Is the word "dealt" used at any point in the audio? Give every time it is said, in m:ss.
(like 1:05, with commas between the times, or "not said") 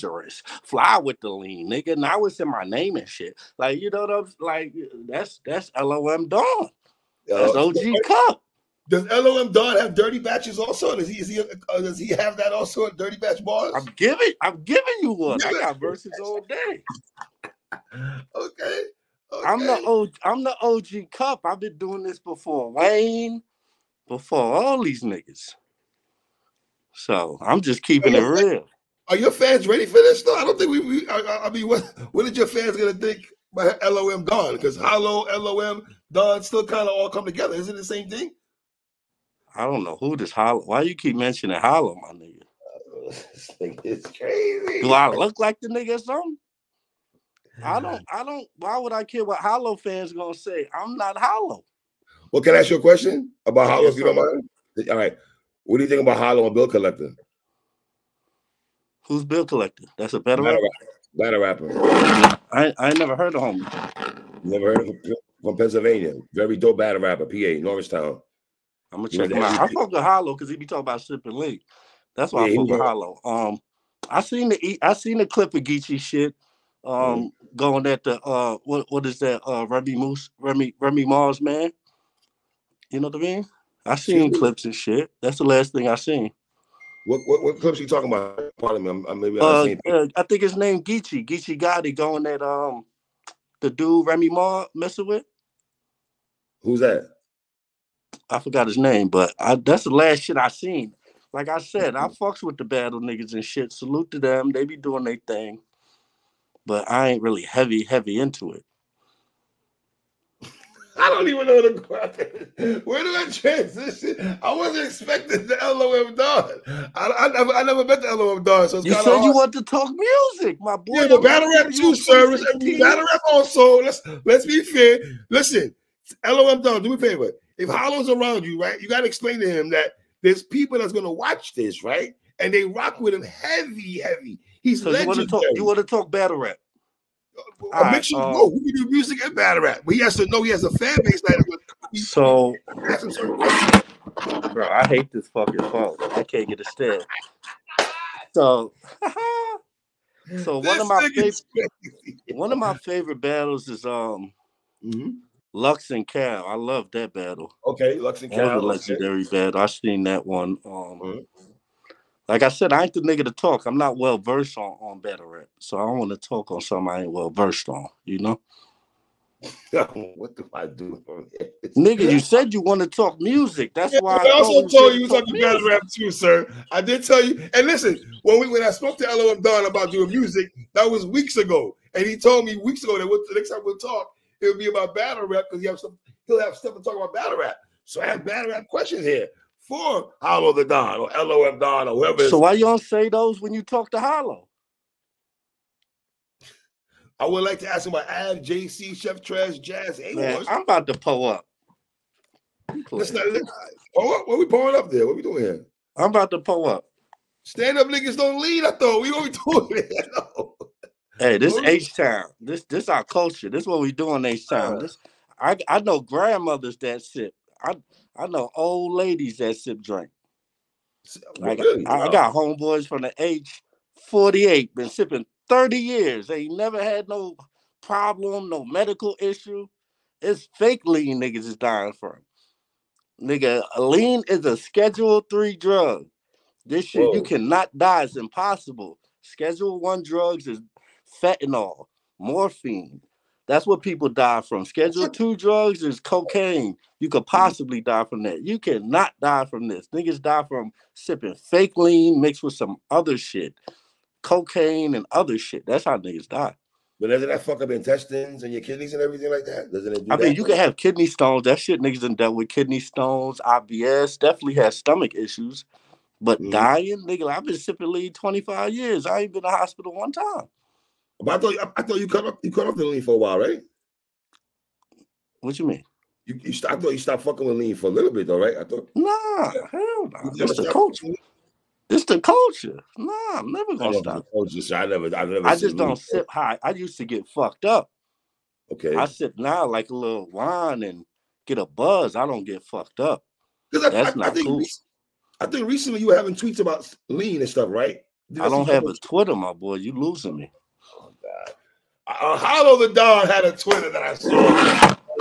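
4:22.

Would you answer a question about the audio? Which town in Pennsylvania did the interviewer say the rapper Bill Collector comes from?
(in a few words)
Norristown.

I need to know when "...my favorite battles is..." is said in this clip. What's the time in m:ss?
2:32.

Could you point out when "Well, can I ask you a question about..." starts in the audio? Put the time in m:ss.
0:52.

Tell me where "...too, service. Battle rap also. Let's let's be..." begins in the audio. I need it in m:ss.
2:01.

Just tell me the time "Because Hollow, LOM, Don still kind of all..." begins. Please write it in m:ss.
0:34.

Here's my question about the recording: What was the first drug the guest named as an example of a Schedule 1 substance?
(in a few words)
Fentanyl.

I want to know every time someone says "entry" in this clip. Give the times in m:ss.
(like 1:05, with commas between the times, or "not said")
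not said.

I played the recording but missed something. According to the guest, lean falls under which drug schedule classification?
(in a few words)
Schedule 3.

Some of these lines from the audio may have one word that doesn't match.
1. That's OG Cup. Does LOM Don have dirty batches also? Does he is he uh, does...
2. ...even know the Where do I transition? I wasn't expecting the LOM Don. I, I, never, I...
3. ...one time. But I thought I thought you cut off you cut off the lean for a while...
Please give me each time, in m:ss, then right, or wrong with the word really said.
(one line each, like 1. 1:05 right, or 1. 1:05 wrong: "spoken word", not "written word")
1. 0:07 right
2. 1:51 right
3. 4:29 right.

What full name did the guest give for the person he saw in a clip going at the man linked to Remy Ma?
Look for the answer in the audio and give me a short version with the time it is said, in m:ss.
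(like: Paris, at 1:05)
Geechee Gotti, at 1:31.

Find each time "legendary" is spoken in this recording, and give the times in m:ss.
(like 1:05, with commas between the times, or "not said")
2:14, 2:38.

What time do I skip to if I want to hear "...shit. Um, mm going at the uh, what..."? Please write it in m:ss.
1:15.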